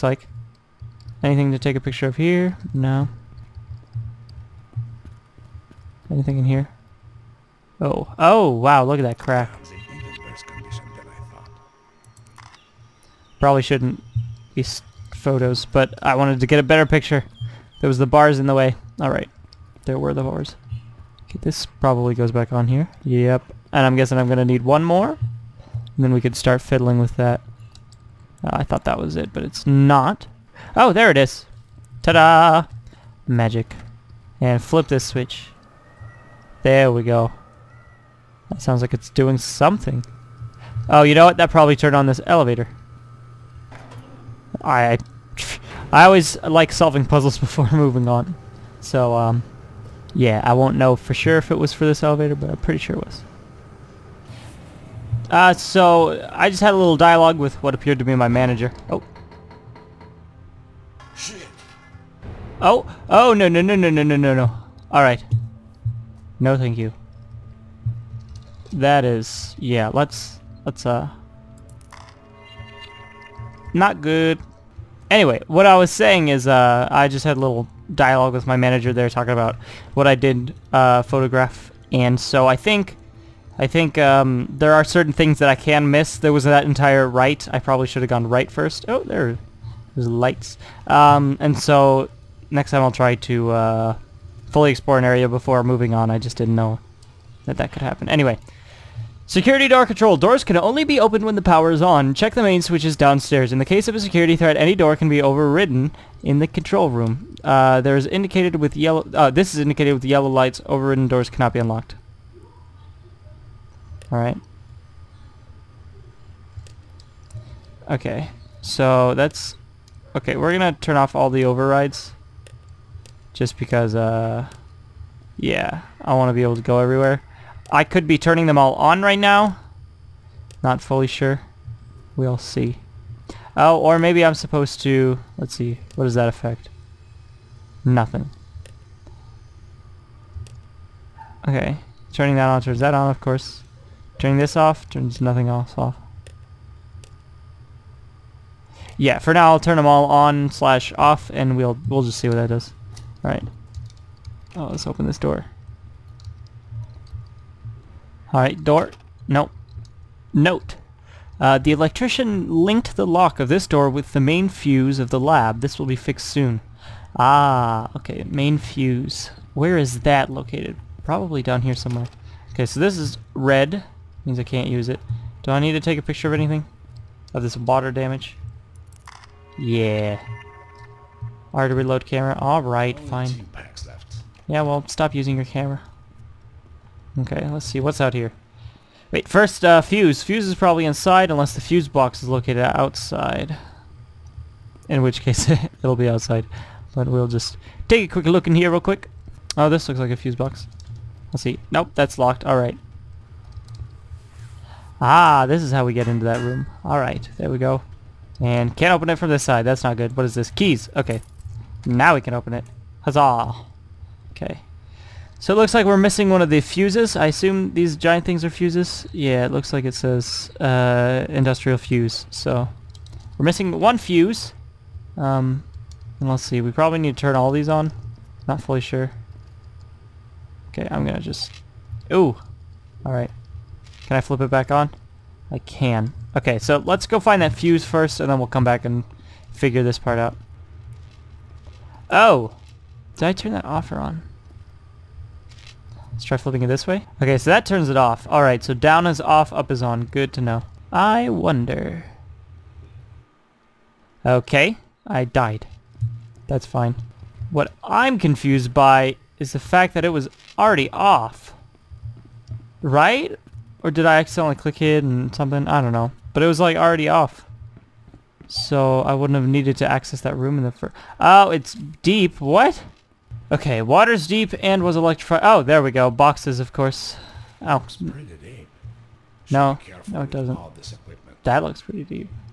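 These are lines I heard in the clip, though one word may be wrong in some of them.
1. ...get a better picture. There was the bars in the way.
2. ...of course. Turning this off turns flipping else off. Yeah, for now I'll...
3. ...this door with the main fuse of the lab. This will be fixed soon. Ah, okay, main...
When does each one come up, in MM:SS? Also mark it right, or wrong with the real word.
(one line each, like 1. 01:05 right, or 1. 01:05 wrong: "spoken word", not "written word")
1. 00:16 right
2. 02:23 wrong: "nothing", not "flipping"
3. 02:43 right.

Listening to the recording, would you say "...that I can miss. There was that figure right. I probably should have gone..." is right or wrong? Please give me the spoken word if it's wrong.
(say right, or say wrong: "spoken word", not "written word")
wrong: "entire", not "figure".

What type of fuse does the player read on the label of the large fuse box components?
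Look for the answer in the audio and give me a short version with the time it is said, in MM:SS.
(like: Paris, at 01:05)
Industrial fuse, at 03:41.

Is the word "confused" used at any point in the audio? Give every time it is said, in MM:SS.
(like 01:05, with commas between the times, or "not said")
04:18.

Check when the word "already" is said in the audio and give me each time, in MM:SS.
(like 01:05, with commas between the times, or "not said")
04:20, 04:26.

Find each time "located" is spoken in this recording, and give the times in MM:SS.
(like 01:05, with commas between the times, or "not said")
02:50, 03:12.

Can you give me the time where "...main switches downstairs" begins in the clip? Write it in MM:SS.
01:42.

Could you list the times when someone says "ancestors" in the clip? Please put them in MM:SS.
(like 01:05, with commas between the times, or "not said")
not said.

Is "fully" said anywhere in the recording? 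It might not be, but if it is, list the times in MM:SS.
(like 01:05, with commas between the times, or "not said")
01:34, 02:10, 03:48.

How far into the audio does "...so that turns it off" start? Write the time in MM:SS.
04:07.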